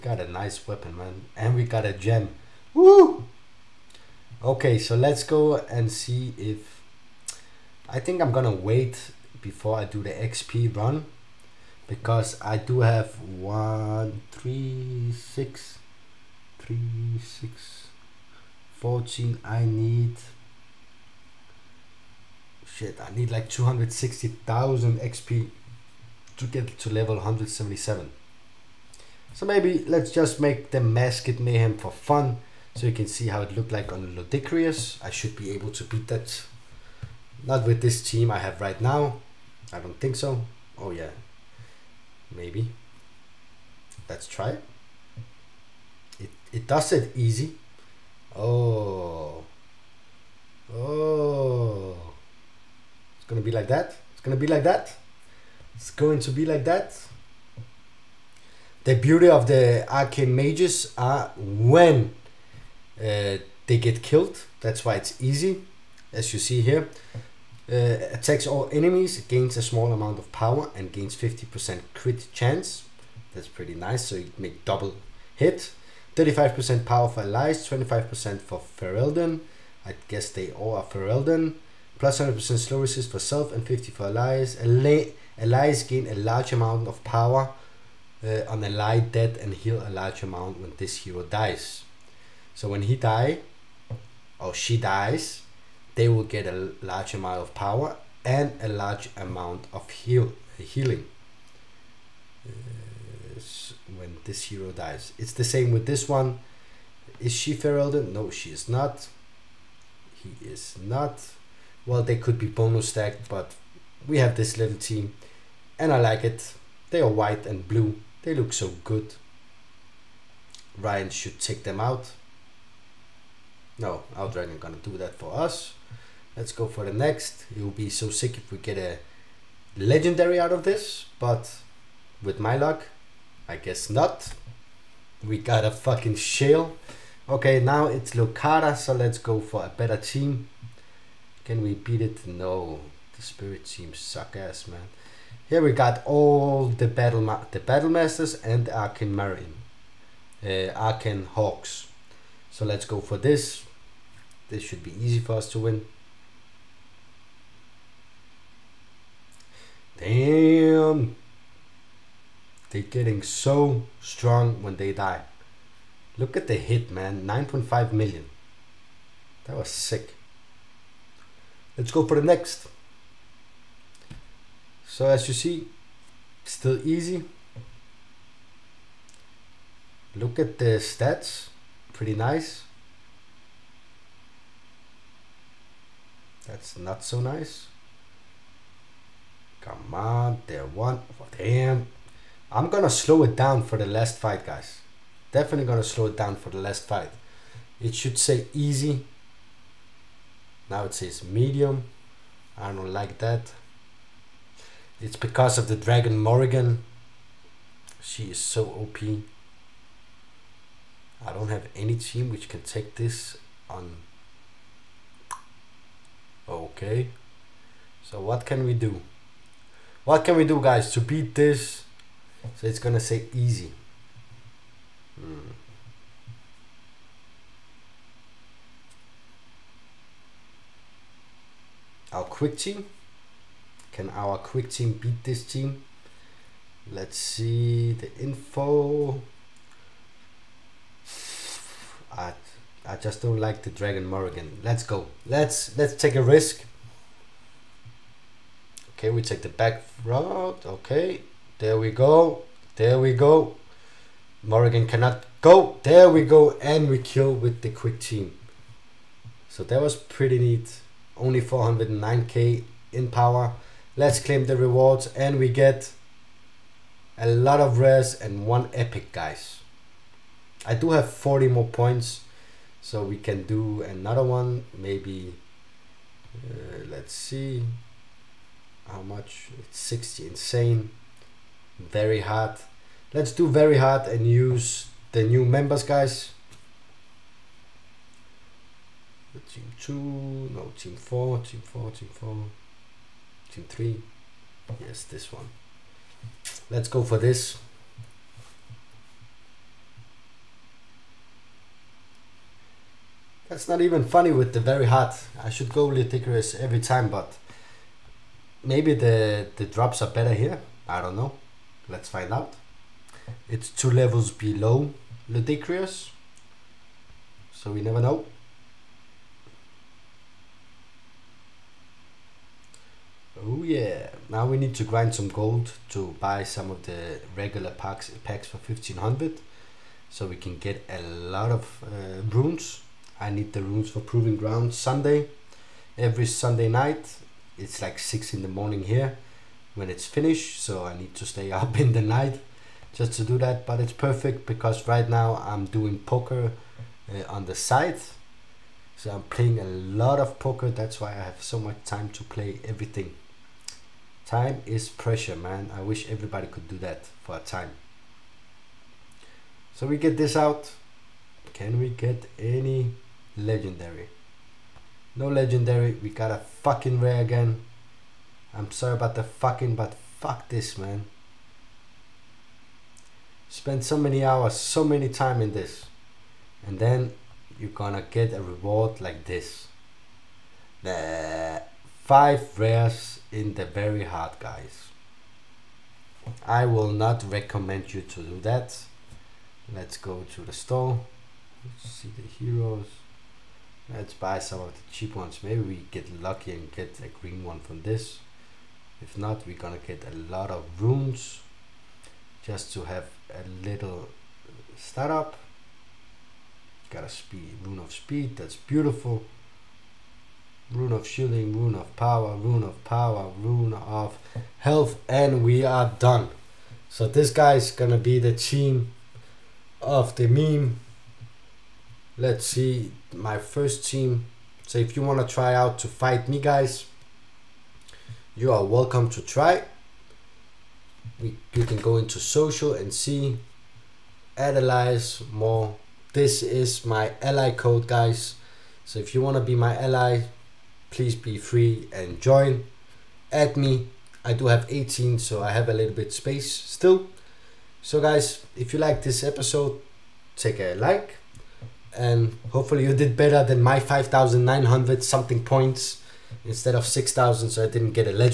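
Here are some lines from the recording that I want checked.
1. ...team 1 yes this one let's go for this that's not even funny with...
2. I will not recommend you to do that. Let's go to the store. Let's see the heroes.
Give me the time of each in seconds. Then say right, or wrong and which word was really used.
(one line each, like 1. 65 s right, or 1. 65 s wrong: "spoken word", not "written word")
1. 293 s wrong: "3", not "1"
2. 386 s right.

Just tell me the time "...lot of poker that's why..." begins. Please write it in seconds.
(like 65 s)
349 s.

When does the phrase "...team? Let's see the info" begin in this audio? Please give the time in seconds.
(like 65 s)
235 s.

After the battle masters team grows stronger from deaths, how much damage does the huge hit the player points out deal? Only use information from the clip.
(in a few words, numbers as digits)
9.5 million.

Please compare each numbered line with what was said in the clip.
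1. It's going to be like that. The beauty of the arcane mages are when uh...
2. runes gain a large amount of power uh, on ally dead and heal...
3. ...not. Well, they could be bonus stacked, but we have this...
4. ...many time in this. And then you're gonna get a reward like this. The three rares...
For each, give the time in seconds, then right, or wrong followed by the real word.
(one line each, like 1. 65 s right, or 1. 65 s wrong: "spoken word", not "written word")
1. 55 s right
2. 85 s wrong: "allies", not "runes"
3. 110 s right
4. 374 s wrong: "five", not "three".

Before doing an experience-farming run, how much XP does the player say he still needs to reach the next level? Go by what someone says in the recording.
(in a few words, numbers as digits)
260,000.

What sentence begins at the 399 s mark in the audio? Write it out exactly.
If not, we're gonna get a lot of runes, just to have a little startup.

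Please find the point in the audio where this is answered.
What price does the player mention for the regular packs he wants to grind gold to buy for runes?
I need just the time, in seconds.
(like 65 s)
328 s.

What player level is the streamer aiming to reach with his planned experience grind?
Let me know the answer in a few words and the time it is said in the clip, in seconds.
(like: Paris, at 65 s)
177, at 27 s.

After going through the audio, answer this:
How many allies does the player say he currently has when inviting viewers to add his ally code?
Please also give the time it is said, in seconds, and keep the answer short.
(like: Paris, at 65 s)
18, at 444 s.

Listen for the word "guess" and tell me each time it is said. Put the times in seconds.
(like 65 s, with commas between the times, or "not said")
80 s, 133 s.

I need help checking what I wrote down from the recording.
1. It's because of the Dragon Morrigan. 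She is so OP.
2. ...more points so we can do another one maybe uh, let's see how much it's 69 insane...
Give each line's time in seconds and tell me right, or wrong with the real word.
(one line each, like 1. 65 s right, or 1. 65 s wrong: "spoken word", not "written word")
1. 205 s right
2. 271 s wrong: "60", not "69".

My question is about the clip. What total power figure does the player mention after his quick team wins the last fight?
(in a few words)
409k.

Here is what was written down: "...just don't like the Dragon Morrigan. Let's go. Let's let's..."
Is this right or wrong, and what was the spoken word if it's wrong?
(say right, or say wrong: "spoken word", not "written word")
right.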